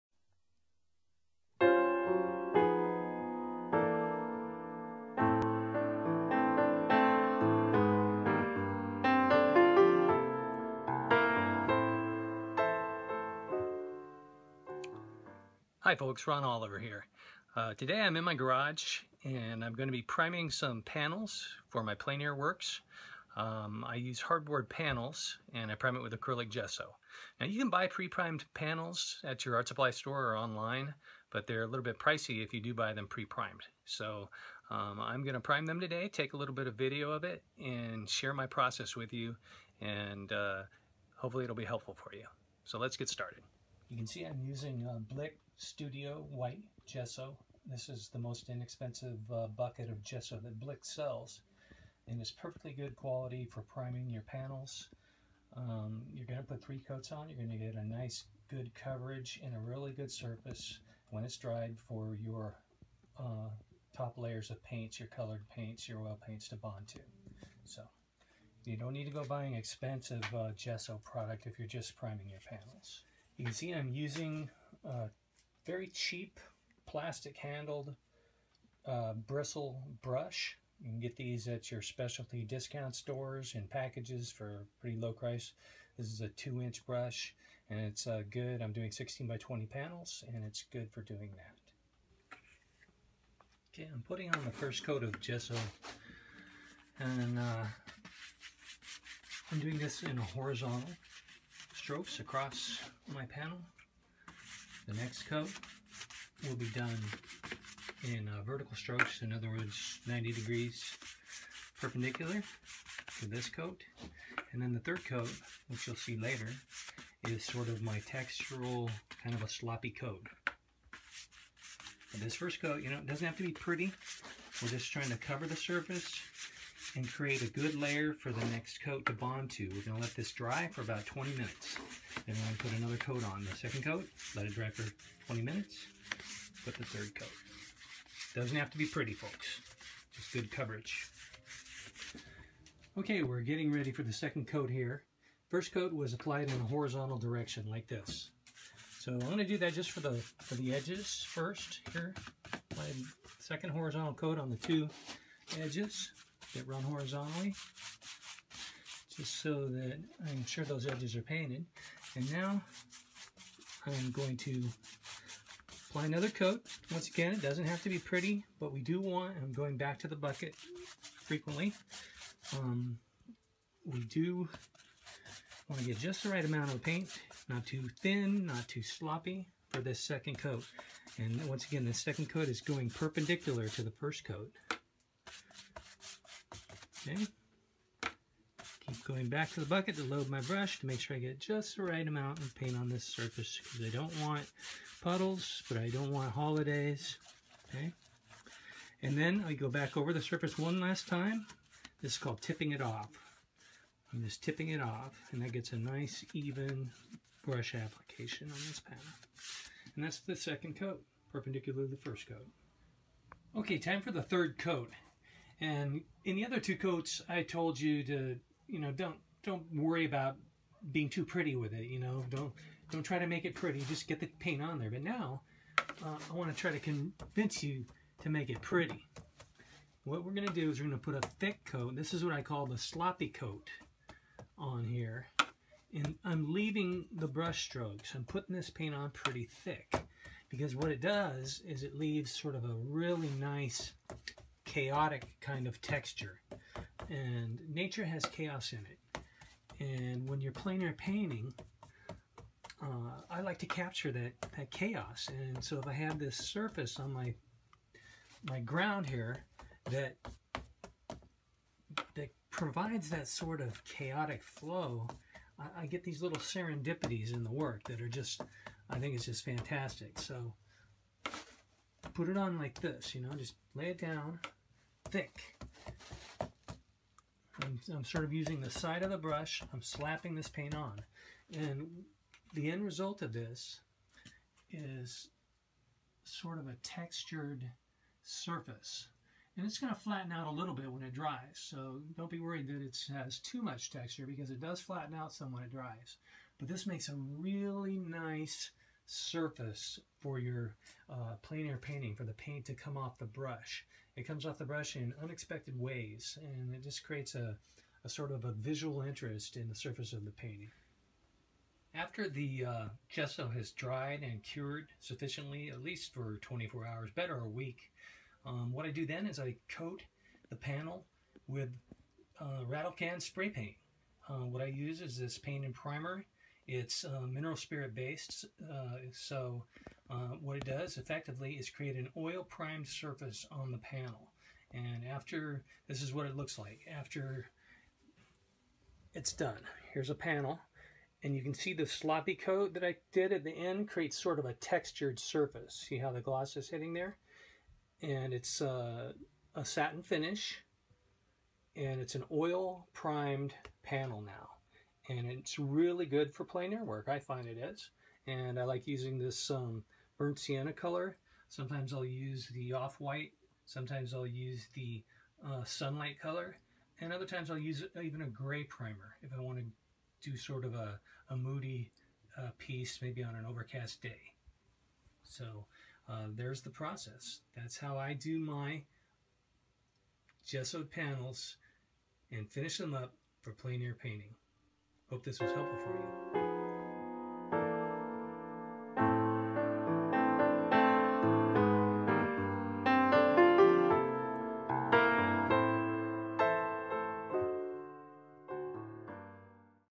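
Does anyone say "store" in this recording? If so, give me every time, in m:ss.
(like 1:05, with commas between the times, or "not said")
0:29, 1:22.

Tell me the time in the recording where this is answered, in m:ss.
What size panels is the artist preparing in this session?
1:28.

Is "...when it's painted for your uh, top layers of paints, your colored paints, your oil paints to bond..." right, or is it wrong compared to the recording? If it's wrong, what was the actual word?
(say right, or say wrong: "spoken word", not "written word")
wrong: "dried", not "painted".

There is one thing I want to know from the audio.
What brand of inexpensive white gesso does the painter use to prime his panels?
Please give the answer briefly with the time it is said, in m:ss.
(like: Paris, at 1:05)
Blick Studio, at 0:45.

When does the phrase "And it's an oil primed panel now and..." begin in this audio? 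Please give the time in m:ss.
5:51.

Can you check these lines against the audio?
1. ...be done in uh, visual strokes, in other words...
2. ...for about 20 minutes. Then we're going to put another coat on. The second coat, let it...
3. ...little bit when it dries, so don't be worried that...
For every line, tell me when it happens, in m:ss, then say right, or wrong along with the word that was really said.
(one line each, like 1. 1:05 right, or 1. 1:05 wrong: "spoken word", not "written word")
1. 1:46 wrong: "vertical", not "visual"
2. 2:10 right
3. 4:50 right.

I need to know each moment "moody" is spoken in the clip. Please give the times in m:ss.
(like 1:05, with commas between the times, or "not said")
6:11.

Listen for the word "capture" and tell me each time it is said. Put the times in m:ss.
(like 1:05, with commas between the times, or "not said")
4:13.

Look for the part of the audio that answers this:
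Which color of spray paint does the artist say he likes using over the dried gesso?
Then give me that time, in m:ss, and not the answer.
6:00.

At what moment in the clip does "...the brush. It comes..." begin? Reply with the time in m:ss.
5:03.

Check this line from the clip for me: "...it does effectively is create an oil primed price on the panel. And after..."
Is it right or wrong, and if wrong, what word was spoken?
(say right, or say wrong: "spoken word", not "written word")
wrong: "surface", not "price".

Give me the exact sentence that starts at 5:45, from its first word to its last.
See how the gloss is hitting there?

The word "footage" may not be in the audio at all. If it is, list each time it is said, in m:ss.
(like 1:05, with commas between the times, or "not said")
not said.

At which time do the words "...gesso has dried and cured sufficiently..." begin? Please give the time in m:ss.
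5:13.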